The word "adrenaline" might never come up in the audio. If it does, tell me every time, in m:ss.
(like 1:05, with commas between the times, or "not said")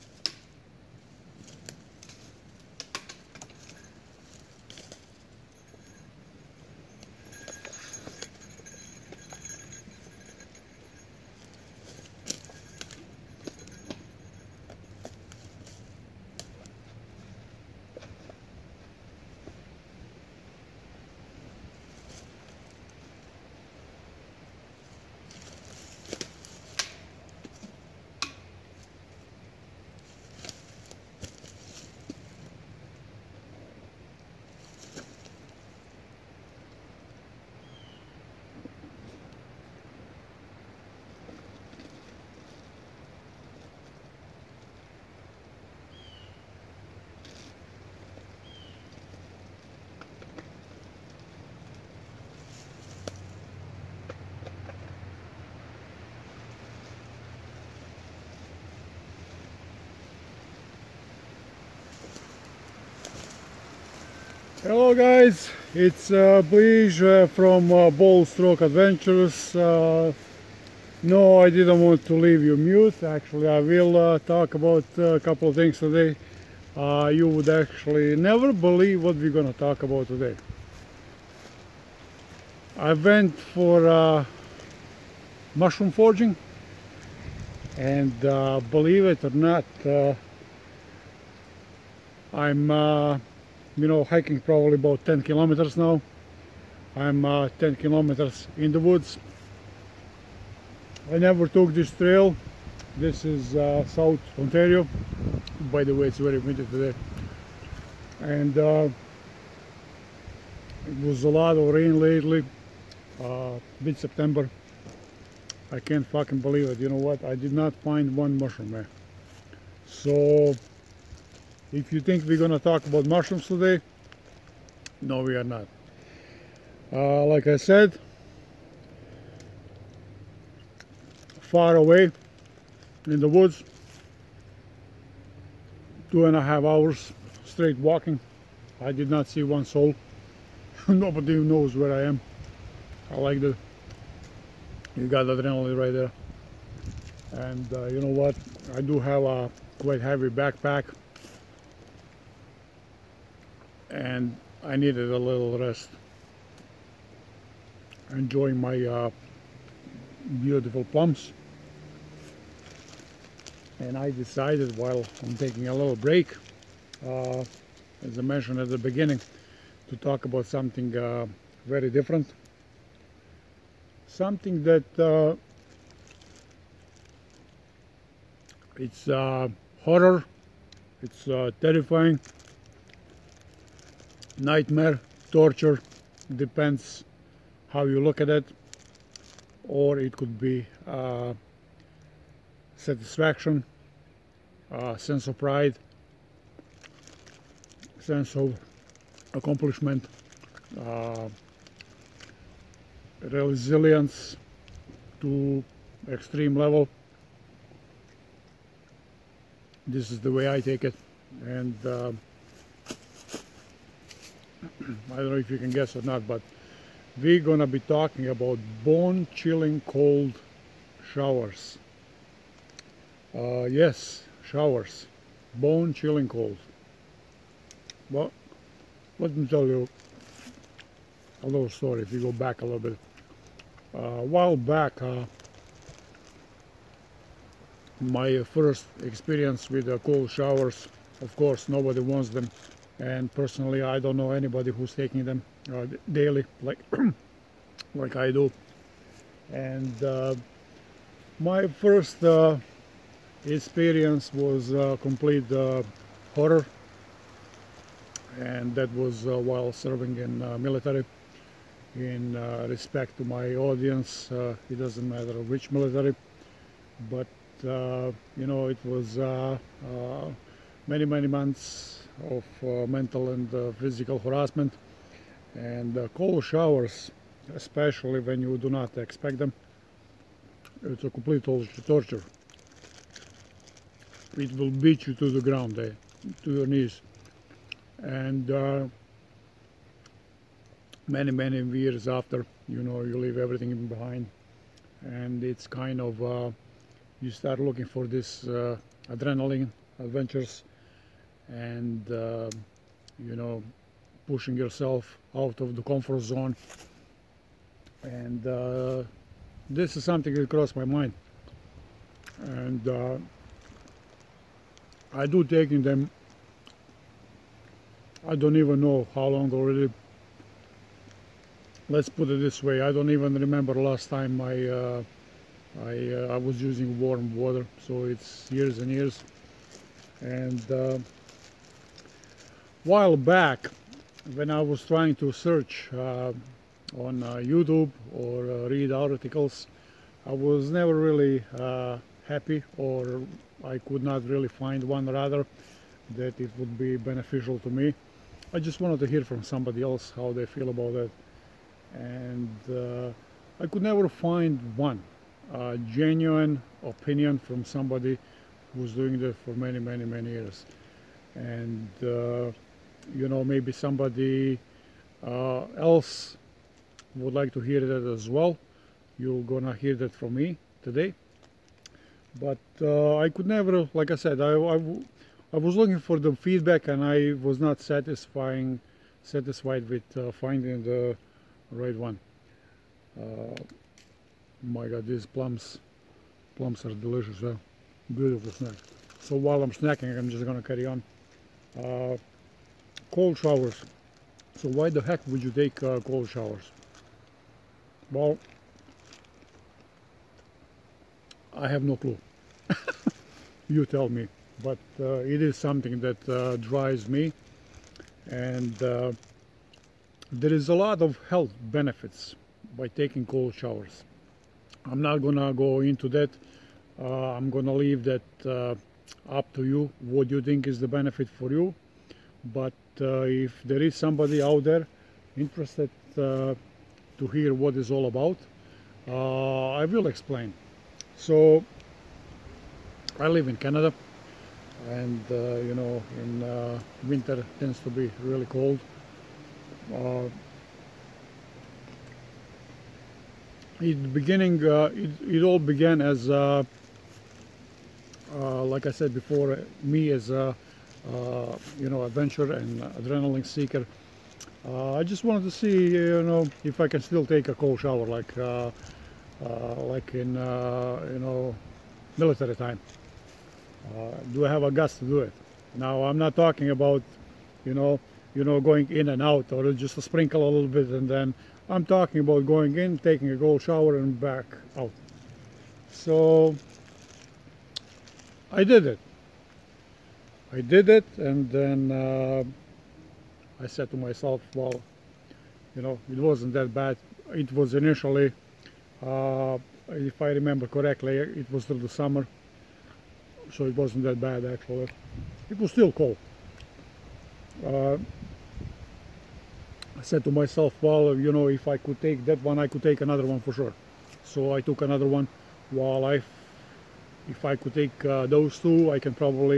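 2:25, 4:59, 7:32.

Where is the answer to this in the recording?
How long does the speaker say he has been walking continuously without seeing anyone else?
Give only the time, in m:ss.
2:16.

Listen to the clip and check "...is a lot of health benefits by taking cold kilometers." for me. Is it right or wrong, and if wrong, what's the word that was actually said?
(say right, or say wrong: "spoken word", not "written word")
wrong: "showers", not "kilometers".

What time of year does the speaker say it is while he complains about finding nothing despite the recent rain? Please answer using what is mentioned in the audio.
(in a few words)
mid-September.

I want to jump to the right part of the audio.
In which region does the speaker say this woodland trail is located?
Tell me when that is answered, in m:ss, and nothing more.
1:43.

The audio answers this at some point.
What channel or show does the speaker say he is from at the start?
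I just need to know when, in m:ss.
1:08.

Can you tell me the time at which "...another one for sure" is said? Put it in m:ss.
8:23.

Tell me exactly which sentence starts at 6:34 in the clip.
So why the heck would you take uh, cold showers?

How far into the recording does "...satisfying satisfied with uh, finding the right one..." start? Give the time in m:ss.
6:17.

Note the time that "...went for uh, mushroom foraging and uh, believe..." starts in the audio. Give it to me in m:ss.
1:22.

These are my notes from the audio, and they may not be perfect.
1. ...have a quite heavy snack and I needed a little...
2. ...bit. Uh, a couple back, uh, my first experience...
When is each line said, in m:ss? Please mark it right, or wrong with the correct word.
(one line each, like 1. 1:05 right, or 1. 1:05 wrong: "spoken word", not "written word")
1. 2:28 wrong: "backpack", not "snack"
2. 3:52 wrong: "while", not "couple".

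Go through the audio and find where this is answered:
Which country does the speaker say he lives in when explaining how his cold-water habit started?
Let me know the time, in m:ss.
7:13.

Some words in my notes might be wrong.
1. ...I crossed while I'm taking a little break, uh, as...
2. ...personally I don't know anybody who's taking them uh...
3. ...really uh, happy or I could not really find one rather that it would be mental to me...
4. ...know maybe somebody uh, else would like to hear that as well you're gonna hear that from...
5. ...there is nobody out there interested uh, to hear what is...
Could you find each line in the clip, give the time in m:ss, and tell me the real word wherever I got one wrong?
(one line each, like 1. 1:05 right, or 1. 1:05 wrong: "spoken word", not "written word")
1. 2:43 wrong: "decided", not "crossed"
2. 4:03 right
3. 5:40 wrong: "beneficial", not "mental"
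4. 6:03 right
5. 7:03 wrong: "somebody", not "nobody".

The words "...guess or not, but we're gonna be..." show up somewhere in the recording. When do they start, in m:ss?
3:35.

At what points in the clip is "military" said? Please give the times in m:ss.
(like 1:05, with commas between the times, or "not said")
4:20, 4:25, 7:42.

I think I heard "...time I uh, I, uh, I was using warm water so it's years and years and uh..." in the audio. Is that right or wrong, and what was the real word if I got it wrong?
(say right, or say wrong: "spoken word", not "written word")
right.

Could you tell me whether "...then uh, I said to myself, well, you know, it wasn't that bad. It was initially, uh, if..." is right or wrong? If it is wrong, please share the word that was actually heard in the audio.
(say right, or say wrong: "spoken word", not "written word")
right.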